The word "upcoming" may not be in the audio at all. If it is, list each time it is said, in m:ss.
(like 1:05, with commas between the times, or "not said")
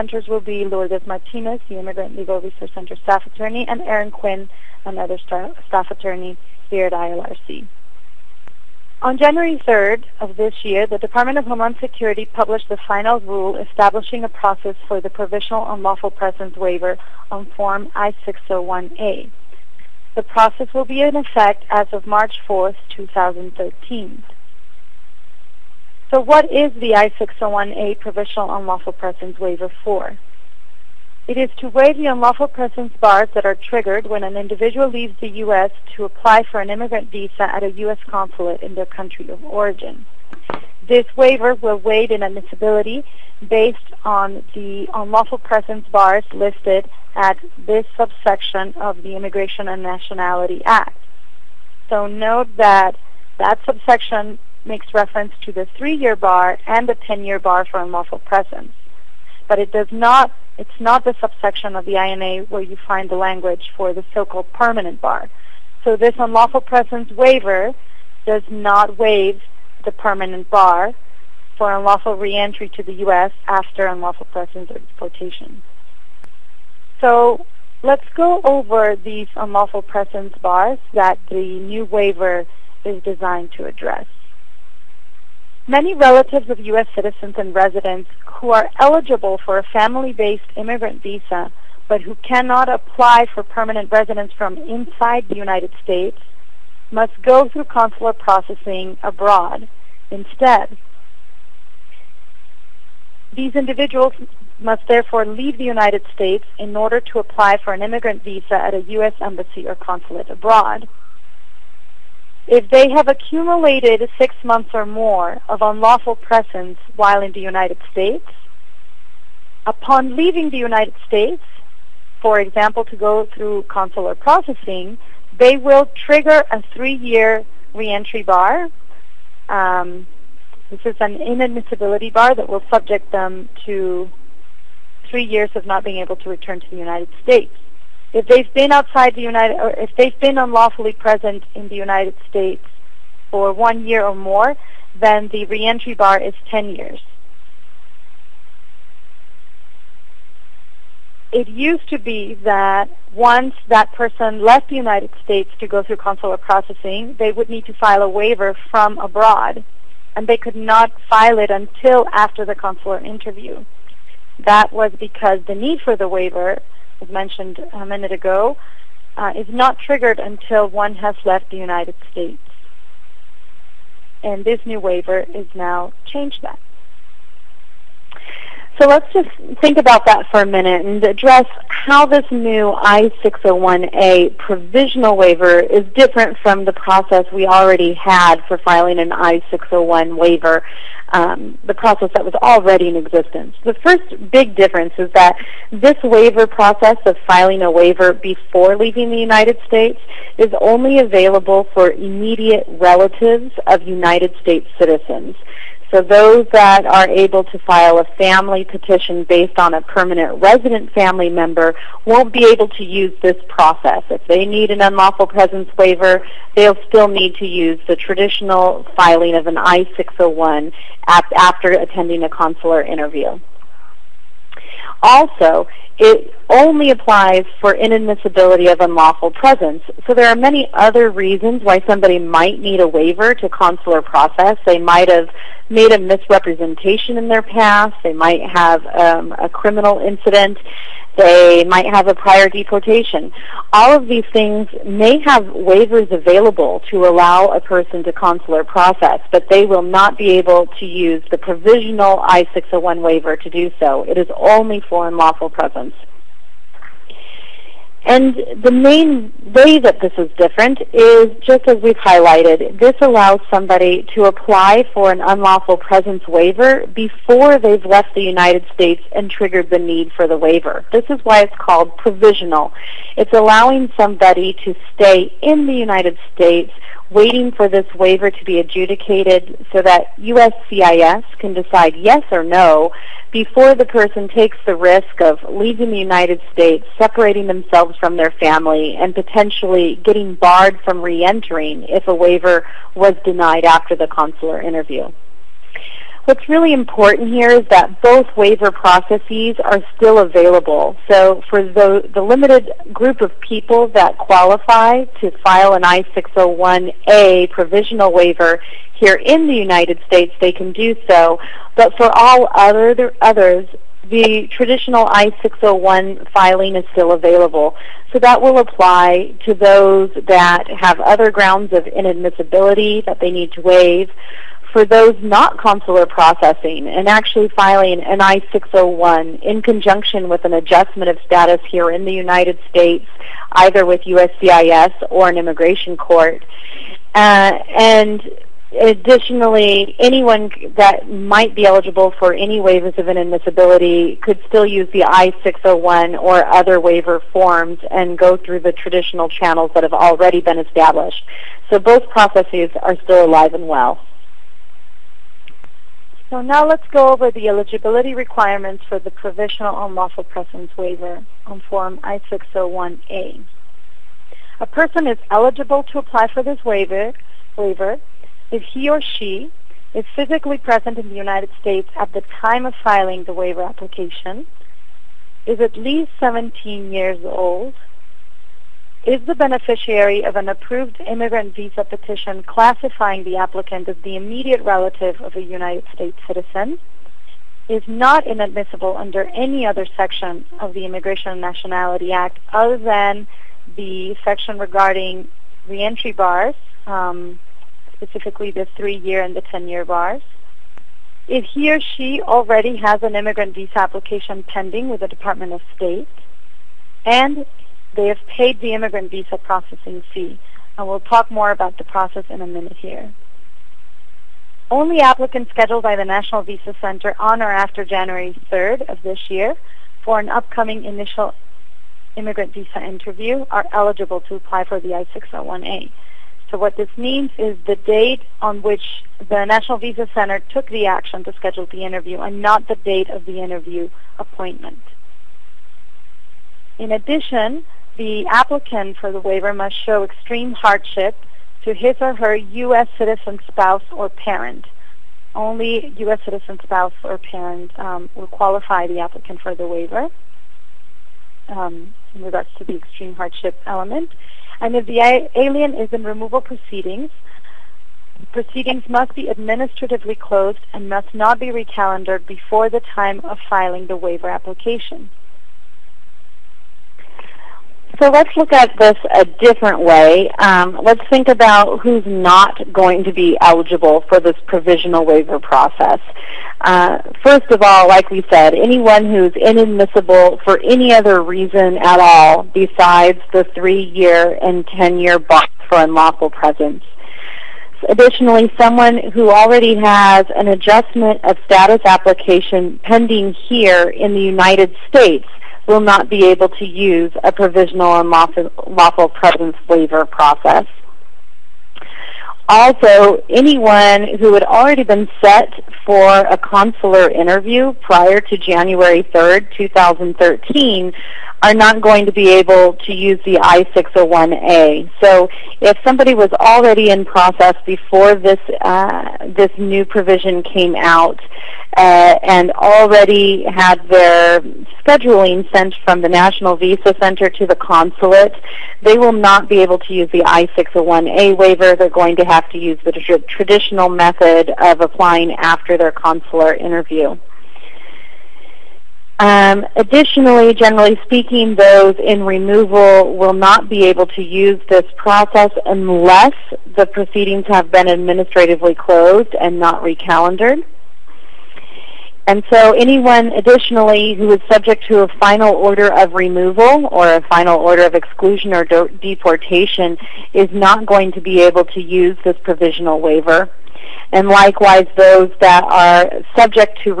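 7:00.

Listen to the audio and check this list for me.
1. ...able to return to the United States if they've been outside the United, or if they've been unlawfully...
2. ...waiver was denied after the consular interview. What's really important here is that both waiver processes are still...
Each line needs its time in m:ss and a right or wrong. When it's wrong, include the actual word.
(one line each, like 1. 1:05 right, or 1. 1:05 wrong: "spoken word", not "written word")
1. 2:15 right
2. 4:52 right.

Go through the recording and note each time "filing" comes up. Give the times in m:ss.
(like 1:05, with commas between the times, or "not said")
3:08, 3:17, 3:38, 5:16, 5:27, 6:12, 7:43.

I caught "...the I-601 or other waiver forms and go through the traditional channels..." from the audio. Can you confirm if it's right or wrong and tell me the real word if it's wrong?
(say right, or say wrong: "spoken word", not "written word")
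right.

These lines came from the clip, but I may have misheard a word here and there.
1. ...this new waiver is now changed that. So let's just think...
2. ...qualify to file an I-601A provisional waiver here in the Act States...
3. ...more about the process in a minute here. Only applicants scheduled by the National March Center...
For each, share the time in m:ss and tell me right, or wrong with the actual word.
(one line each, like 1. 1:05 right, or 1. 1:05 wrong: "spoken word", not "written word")
1. 2:54 right
2. 5:04 wrong: "United", not "Act"
3. 6:51 wrong: "Visa", not "March".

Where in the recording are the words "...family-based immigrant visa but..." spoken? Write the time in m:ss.
1:29.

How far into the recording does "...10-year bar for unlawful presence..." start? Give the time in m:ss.
0:56.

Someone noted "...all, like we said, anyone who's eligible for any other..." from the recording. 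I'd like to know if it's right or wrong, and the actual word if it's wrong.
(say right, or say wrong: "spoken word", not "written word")
wrong: "inadmissible", not "eligible".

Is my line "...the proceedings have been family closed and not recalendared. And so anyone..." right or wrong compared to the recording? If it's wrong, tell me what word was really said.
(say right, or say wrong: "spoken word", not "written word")
wrong: "administratively", not "family".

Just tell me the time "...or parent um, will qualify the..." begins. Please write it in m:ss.
7:27.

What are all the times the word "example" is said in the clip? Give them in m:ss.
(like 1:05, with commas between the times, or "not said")
2:02.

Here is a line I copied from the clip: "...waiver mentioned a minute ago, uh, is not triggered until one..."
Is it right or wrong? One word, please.
right.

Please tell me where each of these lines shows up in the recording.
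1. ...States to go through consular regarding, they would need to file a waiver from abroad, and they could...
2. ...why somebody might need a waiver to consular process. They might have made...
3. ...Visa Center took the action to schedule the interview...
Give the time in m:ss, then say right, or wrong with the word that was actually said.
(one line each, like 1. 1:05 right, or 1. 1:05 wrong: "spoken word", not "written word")
1. 2:35 wrong: "processing", not "regarding"
2. 3:51 right
3. 7:09 right.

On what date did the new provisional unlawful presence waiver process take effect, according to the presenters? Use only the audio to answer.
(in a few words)
March 4th, 2013.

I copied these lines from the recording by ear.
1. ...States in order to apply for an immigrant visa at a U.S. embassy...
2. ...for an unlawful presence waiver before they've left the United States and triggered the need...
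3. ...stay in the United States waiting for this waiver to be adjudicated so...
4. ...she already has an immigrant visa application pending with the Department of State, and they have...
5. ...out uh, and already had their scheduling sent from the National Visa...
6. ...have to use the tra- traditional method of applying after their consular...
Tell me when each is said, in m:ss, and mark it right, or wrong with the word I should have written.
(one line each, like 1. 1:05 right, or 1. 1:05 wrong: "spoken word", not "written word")
1. 1:46 right
2. 4:24 right
3. 4:34 right
4. 6:41 right
5. 8:40 right
6. 8:52 right.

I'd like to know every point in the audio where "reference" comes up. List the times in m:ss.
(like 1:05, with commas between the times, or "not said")
0:54.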